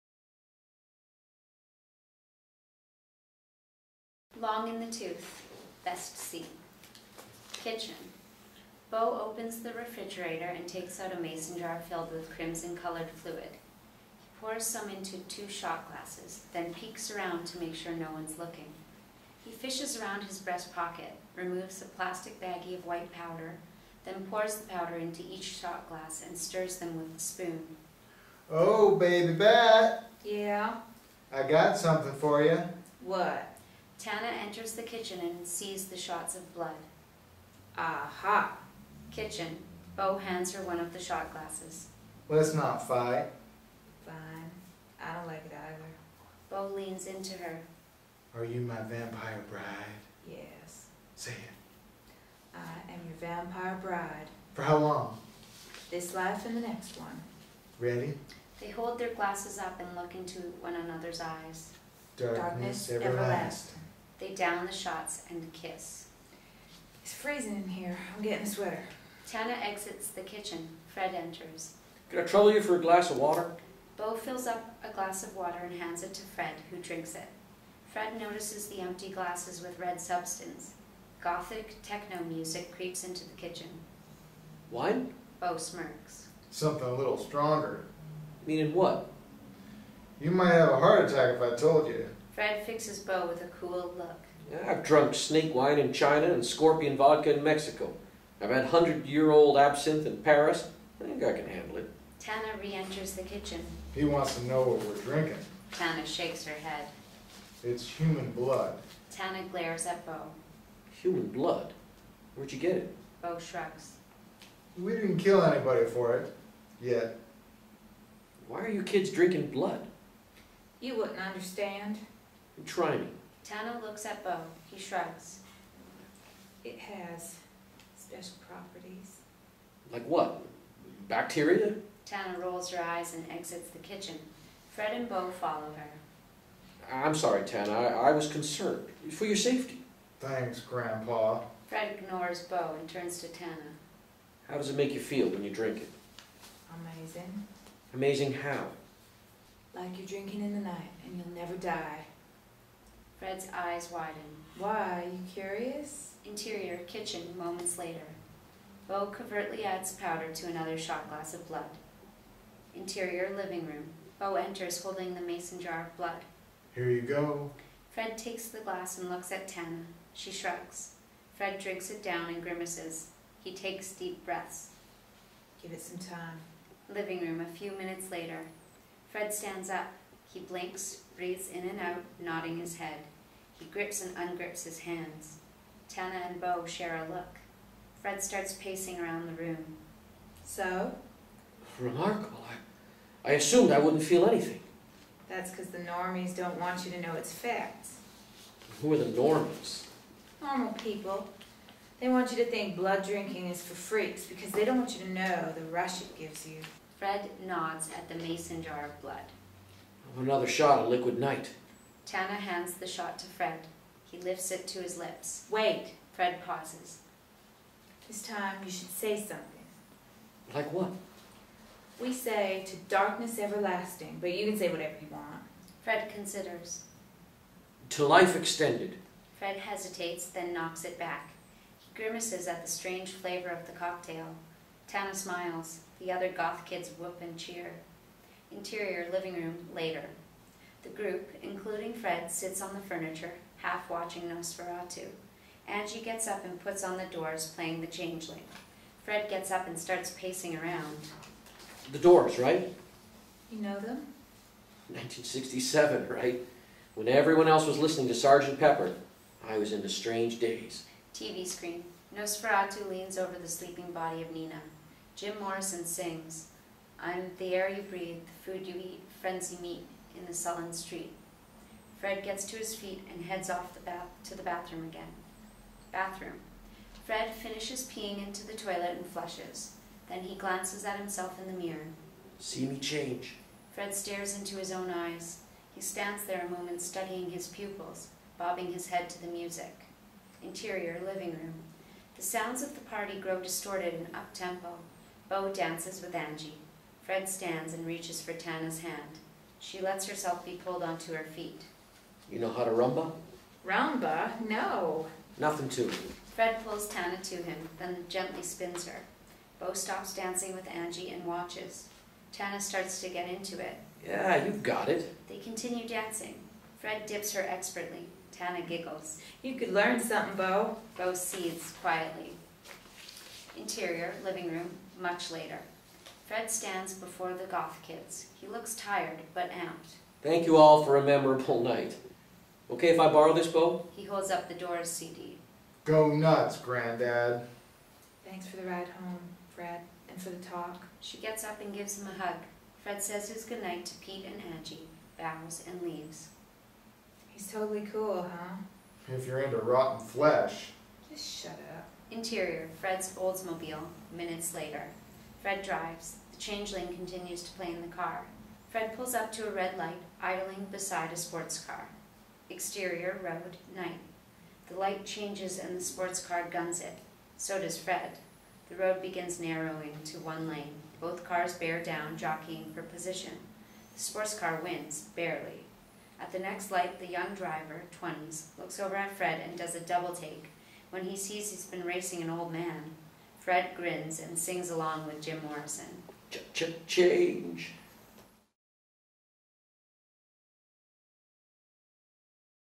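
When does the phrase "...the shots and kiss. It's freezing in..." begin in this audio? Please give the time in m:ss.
1:04.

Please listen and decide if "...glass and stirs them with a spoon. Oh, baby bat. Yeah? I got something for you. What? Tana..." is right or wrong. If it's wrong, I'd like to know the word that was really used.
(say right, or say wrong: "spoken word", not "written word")
right.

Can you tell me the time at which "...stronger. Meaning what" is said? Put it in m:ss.
1:27.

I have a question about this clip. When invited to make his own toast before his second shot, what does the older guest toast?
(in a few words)
life extended.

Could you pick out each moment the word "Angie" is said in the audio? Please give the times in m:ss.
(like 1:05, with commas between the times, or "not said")
4:05, 4:56, 5:10, 5:44.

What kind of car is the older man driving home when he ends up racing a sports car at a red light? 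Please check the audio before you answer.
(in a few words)
Oldsmobile.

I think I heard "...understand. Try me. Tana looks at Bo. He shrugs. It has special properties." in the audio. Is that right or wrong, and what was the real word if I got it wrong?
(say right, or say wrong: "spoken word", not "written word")
right.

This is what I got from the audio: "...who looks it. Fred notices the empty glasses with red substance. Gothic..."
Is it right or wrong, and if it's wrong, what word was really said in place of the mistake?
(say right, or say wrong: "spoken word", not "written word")
wrong: "drinks", not "looks".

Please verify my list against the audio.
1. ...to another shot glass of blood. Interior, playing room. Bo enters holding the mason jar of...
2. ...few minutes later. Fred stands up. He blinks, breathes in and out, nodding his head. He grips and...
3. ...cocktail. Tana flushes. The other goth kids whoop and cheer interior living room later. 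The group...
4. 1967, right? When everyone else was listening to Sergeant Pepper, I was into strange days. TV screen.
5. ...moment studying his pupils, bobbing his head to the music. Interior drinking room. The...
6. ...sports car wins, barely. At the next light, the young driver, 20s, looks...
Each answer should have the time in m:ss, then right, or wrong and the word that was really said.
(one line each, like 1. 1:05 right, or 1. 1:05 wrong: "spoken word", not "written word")
1. 2:40 wrong: "living", not "playing"
2. 2:57 right
3. 3:53 wrong: "smiles", not "flushes"
4. 4:14 right
5. 4:46 wrong: "living", not "drinking"
6. 6:13 right.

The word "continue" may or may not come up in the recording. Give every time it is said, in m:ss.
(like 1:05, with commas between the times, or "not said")
5:15, 5:56.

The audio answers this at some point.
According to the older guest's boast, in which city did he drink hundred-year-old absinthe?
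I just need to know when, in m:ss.
1:40.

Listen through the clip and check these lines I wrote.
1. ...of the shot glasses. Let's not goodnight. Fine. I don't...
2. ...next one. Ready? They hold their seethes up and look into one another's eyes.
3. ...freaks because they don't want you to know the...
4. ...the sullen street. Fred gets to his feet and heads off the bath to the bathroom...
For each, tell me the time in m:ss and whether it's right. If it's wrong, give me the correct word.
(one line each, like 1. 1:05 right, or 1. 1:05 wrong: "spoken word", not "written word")
1. 0:40 wrong: "fight", not "goodnight"
2. 0:56 wrong: "glasses", not "seethes"
3. 3:23 right
4. 4:30 right.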